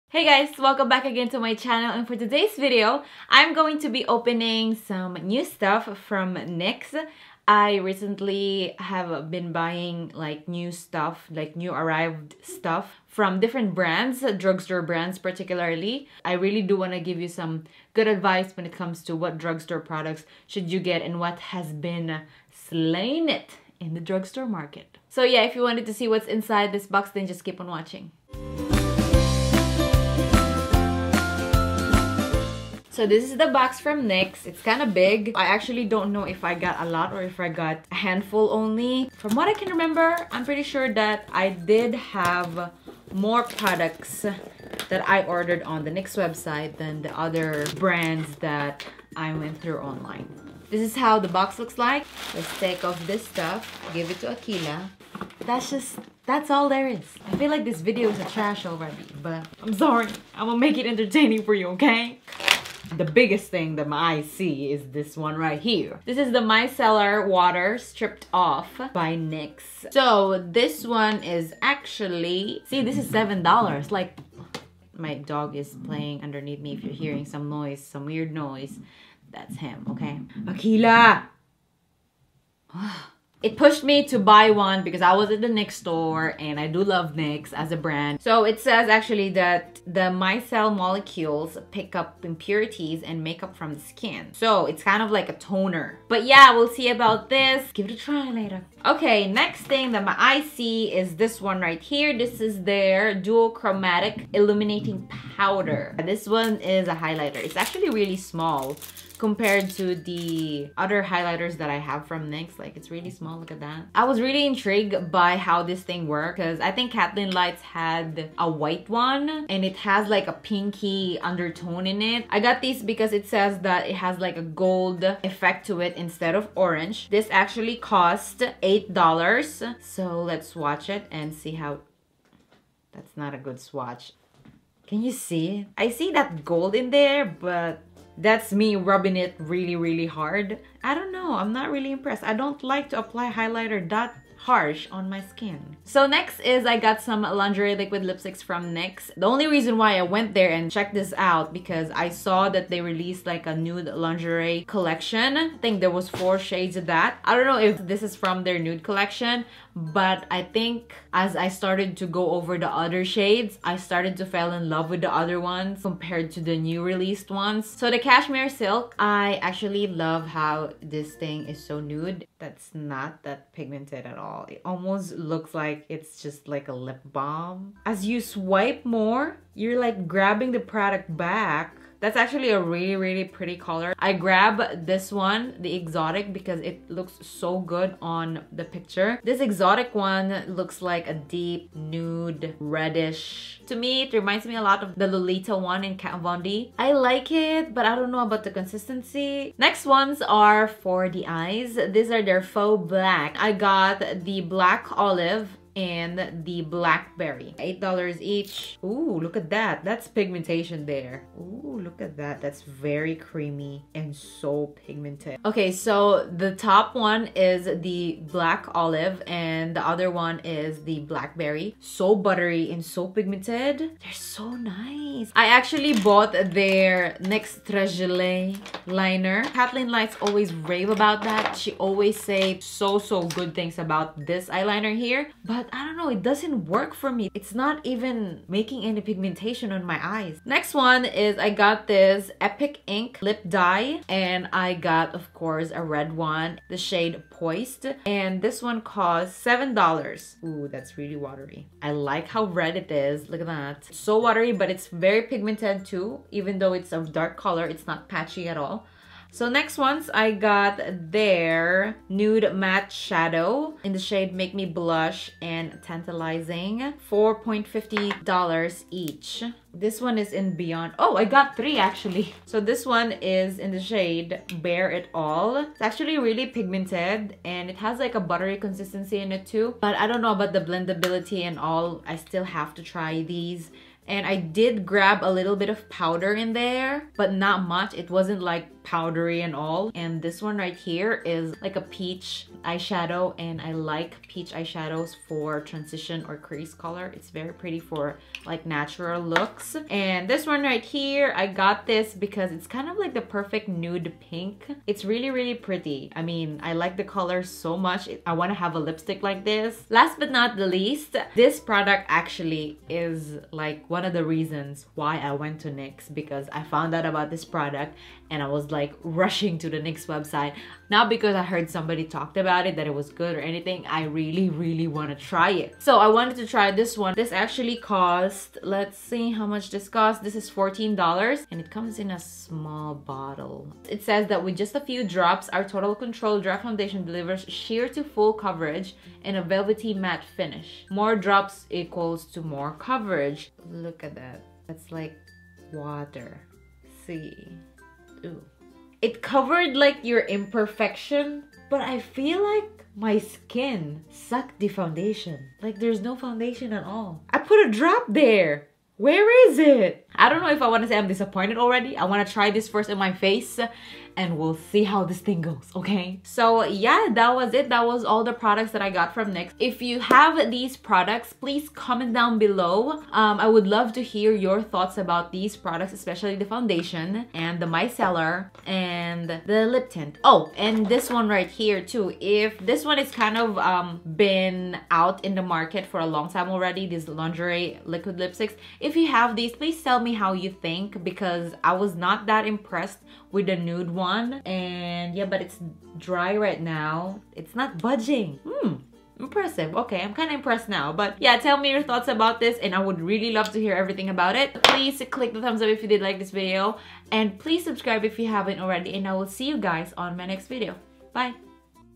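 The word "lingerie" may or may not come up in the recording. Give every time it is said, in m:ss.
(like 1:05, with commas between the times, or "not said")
2:27, 2:34, 6:27.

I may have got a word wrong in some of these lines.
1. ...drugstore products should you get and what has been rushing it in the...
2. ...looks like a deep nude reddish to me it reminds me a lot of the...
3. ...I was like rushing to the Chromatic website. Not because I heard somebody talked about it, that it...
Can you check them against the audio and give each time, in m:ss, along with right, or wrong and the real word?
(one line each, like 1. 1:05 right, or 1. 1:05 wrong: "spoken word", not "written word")
1. 0:19 wrong: "slaying", not "rushing"
2. 3:10 right
3. 5:18 wrong: "NYX", not "Chromatic".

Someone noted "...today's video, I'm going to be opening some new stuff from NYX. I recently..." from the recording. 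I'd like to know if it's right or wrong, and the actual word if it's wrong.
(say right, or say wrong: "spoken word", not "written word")
right.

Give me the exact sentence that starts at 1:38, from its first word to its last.
Okay, next thing that my eye see is this one right here.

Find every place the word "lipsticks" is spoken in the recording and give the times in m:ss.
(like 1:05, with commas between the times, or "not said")
2:28, 5:08, 6:28.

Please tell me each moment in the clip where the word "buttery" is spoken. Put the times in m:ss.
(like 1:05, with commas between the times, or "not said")
3:42, 4:38.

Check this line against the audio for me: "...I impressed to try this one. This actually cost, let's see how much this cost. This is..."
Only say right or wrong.
wrong.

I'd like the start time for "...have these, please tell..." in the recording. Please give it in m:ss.
6:29.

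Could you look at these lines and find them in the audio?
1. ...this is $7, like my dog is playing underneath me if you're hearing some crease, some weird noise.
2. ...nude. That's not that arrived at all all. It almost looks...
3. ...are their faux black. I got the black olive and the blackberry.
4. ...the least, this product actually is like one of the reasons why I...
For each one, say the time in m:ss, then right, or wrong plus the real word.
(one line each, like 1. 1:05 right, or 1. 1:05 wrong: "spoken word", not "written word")
1. 1:12 wrong: "noise", not "crease"
2. 2:51 wrong: "pigmented", not "arrived"
3. 3:22 right
4. 5:10 right.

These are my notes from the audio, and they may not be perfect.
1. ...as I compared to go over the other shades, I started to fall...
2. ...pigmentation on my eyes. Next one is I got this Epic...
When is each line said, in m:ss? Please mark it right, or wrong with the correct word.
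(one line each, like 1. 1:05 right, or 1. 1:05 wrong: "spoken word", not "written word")
1. 2:41 wrong: "started", not "compared"
2. 3:58 right.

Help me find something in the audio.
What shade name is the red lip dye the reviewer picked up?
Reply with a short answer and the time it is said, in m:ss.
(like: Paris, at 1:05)
Poised, at 4:07.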